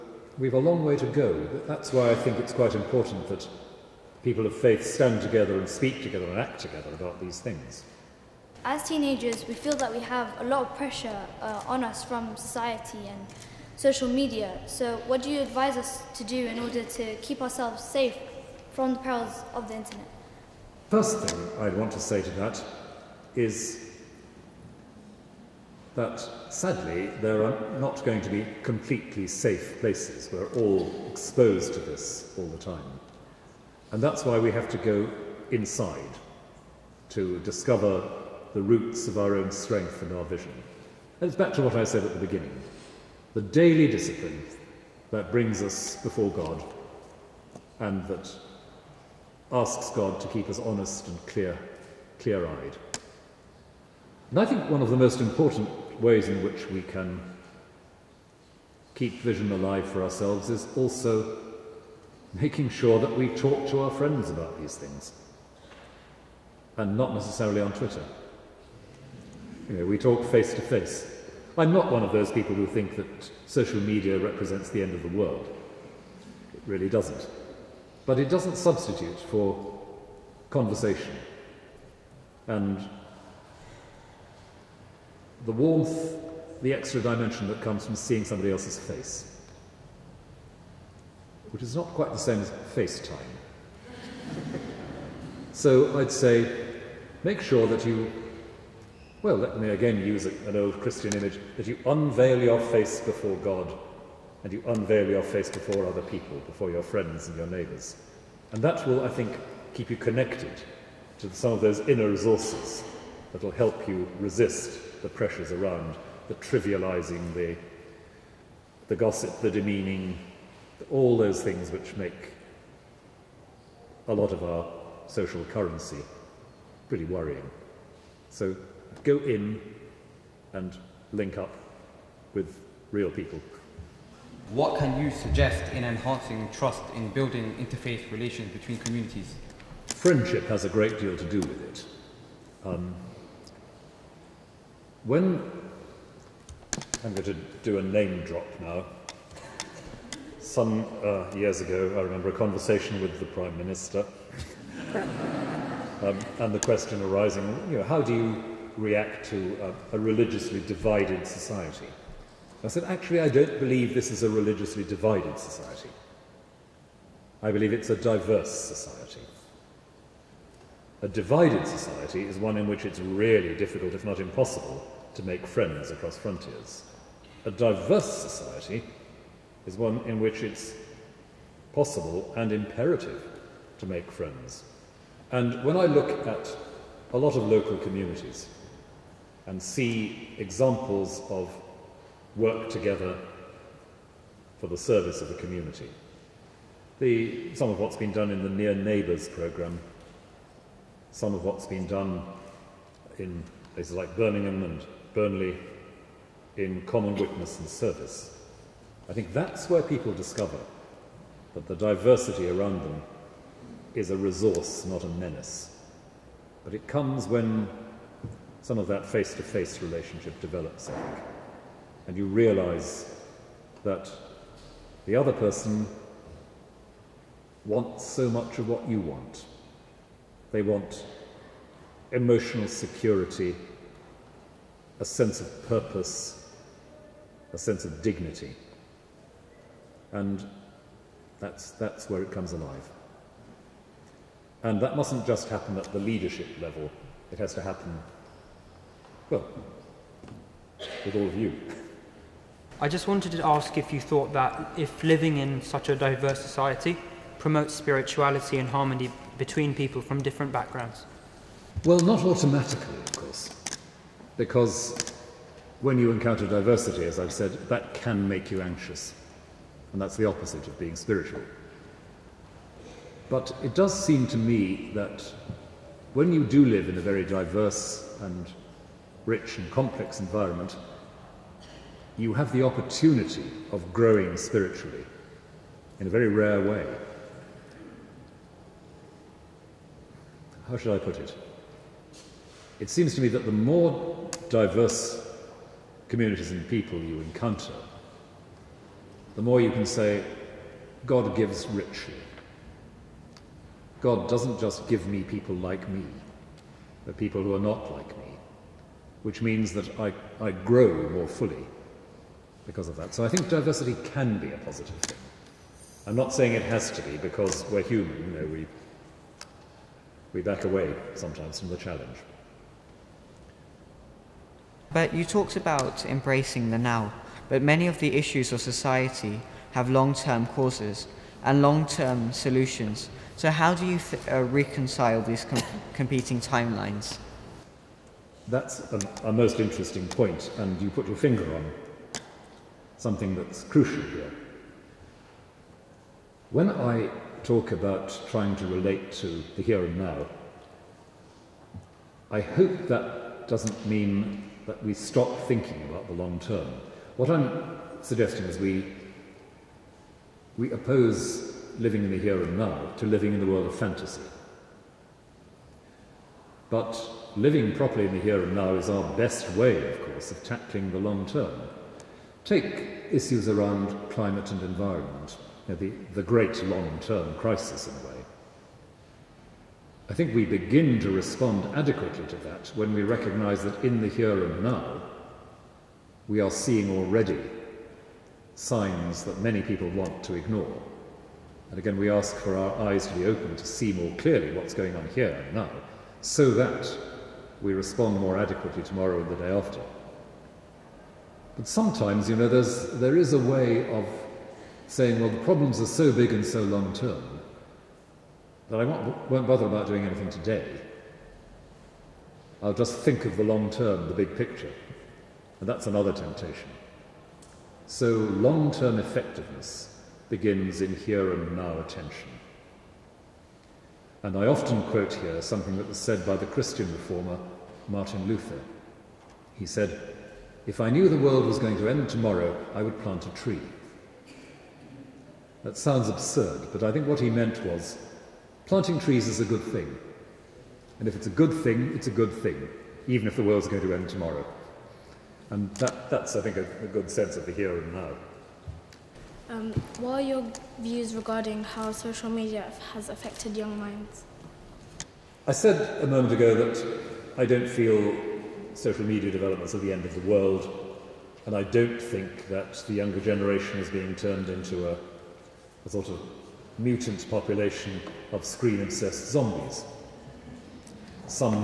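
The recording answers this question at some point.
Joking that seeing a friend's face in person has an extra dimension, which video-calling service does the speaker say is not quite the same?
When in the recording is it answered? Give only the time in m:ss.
1:32.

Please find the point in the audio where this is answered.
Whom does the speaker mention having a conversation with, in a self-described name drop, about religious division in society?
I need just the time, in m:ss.
2:33.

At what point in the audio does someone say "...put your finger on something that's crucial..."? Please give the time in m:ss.
5:40.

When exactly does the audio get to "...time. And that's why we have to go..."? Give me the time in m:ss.
0:32.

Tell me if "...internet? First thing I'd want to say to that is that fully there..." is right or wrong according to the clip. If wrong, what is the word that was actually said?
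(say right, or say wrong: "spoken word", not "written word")
wrong: "sadly", not "fully".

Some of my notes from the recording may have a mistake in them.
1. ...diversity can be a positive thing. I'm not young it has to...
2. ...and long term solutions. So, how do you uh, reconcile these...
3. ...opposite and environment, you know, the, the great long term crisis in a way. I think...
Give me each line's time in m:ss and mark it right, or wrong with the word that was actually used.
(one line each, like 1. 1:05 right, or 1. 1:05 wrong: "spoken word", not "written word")
1. 5:13 wrong: "saying", not "young"
2. 5:31 right
3. 6:14 wrong: "climate", not "opposite".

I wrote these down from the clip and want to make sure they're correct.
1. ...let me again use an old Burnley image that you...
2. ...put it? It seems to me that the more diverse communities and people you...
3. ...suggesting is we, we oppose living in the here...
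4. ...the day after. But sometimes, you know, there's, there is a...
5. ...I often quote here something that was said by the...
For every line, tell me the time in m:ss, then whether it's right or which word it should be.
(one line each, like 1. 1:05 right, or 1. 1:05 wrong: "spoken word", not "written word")
1. 1:39 wrong: "Christian", not "Burnley"
2. 4:51 right
3. 5:58 right
4. 6:39 right
5. 7:04 right.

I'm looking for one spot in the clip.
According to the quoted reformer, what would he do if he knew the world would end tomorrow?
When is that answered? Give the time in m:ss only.
7:13.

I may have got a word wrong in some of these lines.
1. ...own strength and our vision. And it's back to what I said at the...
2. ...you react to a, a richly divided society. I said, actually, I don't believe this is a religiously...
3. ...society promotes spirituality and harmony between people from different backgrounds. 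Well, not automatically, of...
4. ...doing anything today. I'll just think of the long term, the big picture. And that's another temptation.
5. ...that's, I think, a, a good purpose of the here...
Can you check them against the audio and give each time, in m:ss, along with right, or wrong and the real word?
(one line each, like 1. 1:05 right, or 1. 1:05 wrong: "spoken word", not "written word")
1. 0:39 right
2. 2:38 wrong: "religiously", not "richly"
3. 4:16 right
4. 6:49 right
5. 7:26 wrong: "sense", not "purpose".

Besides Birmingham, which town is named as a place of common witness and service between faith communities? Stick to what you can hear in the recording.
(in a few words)
Burnley.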